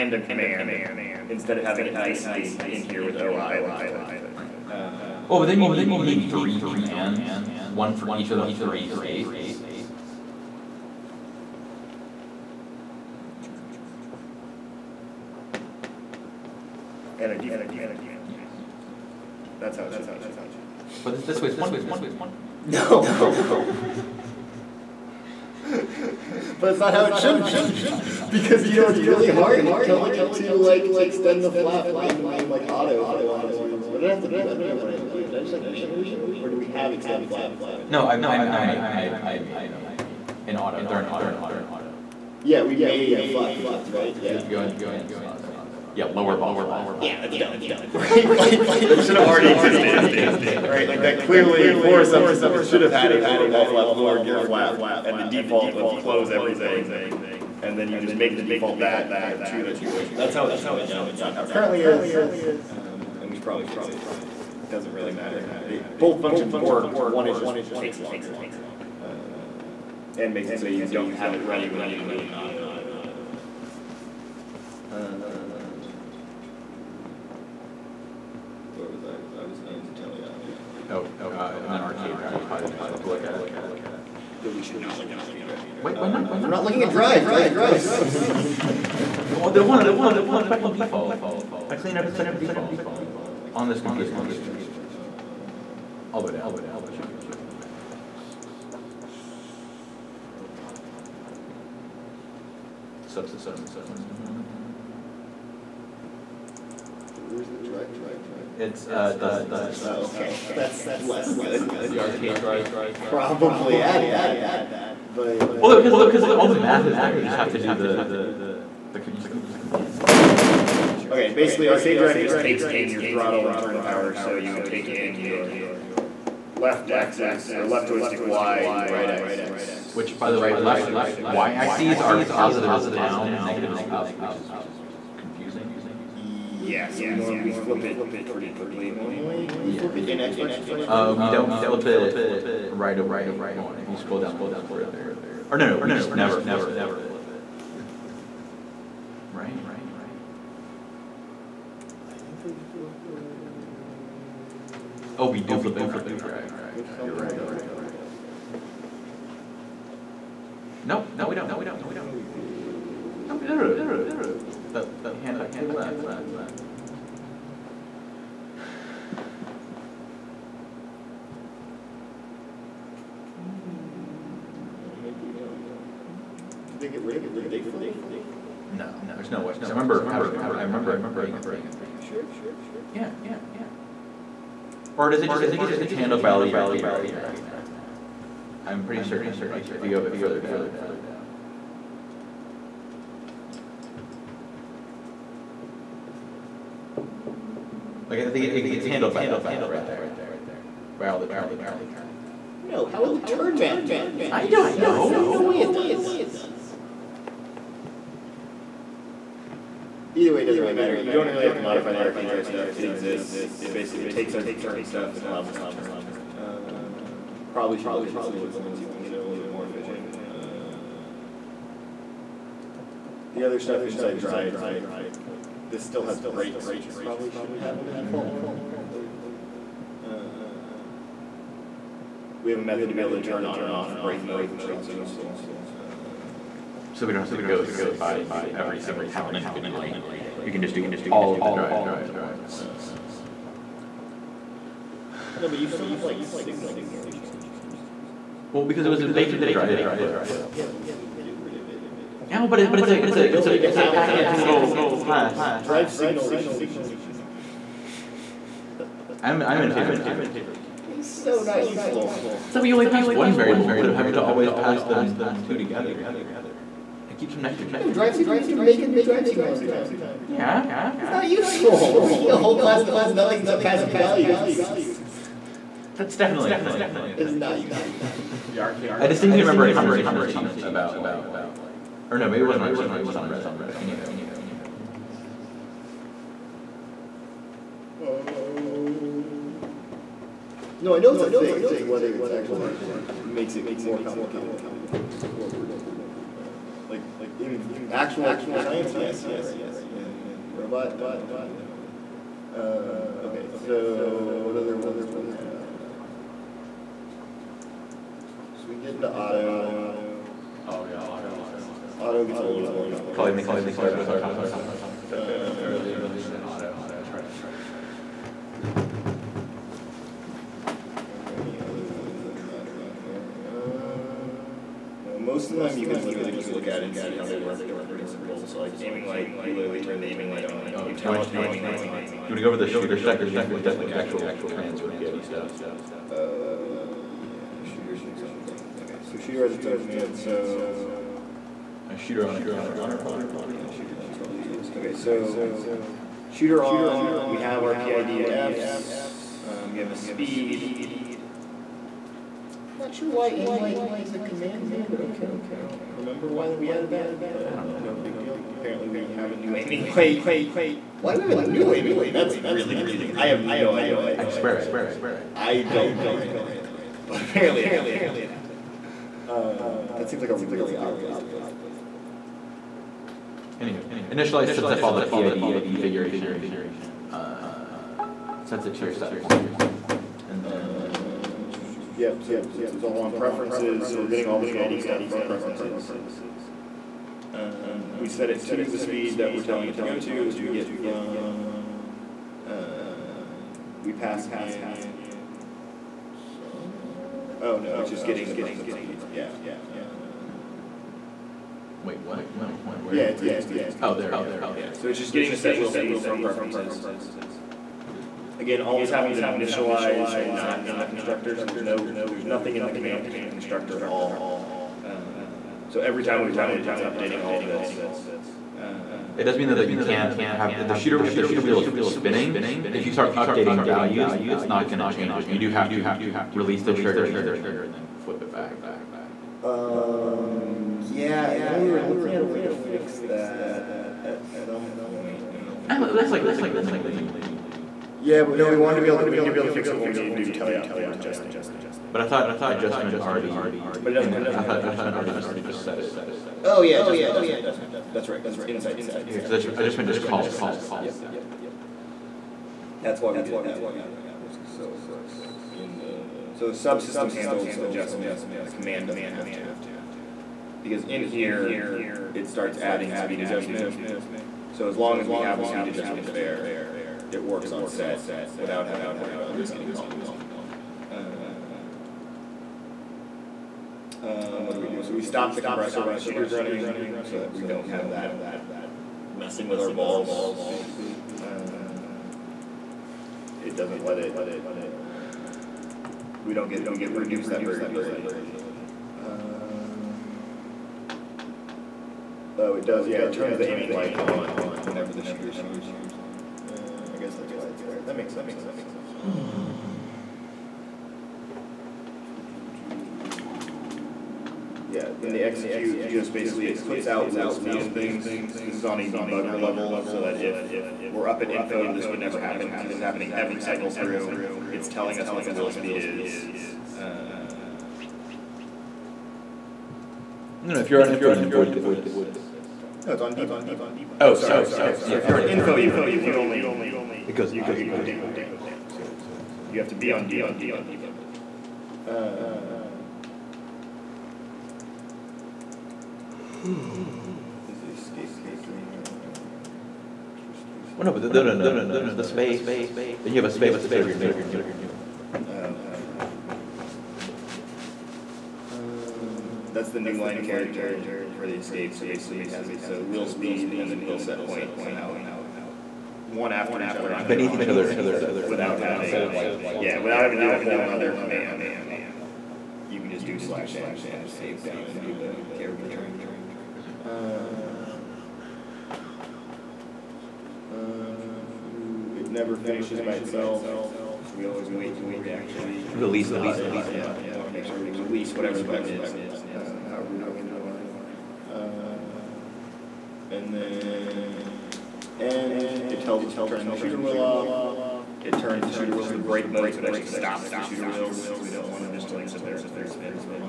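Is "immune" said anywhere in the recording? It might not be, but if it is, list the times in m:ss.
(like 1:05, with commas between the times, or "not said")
not said.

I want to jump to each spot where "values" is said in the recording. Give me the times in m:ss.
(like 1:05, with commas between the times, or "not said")
4:33, 7:03.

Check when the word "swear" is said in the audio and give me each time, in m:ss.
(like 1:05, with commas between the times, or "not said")
6:04.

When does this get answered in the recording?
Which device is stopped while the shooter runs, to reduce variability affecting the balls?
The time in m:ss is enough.
7:55.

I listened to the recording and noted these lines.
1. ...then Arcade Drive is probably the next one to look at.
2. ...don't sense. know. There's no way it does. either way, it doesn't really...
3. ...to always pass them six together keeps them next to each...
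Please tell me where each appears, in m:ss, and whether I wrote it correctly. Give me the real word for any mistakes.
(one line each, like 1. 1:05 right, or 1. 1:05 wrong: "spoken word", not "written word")
1. 1:21 right
2. 3:24 right
3. 4:24 wrong: "two", not "six".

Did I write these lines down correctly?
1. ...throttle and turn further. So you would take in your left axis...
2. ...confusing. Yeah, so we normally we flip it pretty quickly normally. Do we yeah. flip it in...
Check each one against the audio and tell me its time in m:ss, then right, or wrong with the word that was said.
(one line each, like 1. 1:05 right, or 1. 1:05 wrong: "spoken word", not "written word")
1. 2:03 wrong: "power", not "further"
2. 2:15 right.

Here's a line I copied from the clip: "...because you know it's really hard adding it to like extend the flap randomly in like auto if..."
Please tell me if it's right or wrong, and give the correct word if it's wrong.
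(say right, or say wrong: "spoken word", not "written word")
wrong: "telling", not "adding".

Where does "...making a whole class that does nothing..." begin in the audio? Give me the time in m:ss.
4:32.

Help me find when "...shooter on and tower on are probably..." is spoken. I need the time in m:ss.
5:41.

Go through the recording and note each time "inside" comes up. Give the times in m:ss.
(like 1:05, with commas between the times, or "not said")
3:43, 7:28.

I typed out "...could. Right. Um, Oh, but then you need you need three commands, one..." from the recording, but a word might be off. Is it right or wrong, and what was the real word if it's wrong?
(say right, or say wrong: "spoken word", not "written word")
right.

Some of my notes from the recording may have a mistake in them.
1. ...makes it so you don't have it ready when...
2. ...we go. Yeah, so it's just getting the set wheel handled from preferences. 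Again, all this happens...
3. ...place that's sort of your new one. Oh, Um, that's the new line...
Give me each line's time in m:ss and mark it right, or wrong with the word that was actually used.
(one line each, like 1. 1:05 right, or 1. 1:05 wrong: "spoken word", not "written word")
1. 1:10 right
2. 6:44 wrong: "speed", not "handled"
3. 9:03 wrong: "space", not "place".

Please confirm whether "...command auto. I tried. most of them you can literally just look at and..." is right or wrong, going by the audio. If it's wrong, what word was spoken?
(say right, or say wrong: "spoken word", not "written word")
wrong: "understand", not "command".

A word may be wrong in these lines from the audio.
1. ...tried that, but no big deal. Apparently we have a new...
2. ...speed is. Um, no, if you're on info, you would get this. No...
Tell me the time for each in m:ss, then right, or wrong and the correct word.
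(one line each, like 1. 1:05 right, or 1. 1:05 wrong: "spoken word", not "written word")
1. 5:56 wrong: "added", not "tried"
2. 8:35 right.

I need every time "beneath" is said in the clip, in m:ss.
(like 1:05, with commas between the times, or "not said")
9:17.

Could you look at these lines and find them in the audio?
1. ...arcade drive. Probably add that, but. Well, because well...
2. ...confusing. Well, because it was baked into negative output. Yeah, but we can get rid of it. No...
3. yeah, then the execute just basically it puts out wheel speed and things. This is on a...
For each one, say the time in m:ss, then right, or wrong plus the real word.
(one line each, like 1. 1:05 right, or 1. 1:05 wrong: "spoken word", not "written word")
1. 1:52 right
2. 4:07 wrong: "drive", not "negative"
3. 8:24 right.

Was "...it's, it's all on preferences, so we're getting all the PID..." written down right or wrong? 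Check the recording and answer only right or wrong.
right.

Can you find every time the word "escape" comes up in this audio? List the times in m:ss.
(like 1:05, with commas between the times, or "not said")
8:57, 9:11, 9:24.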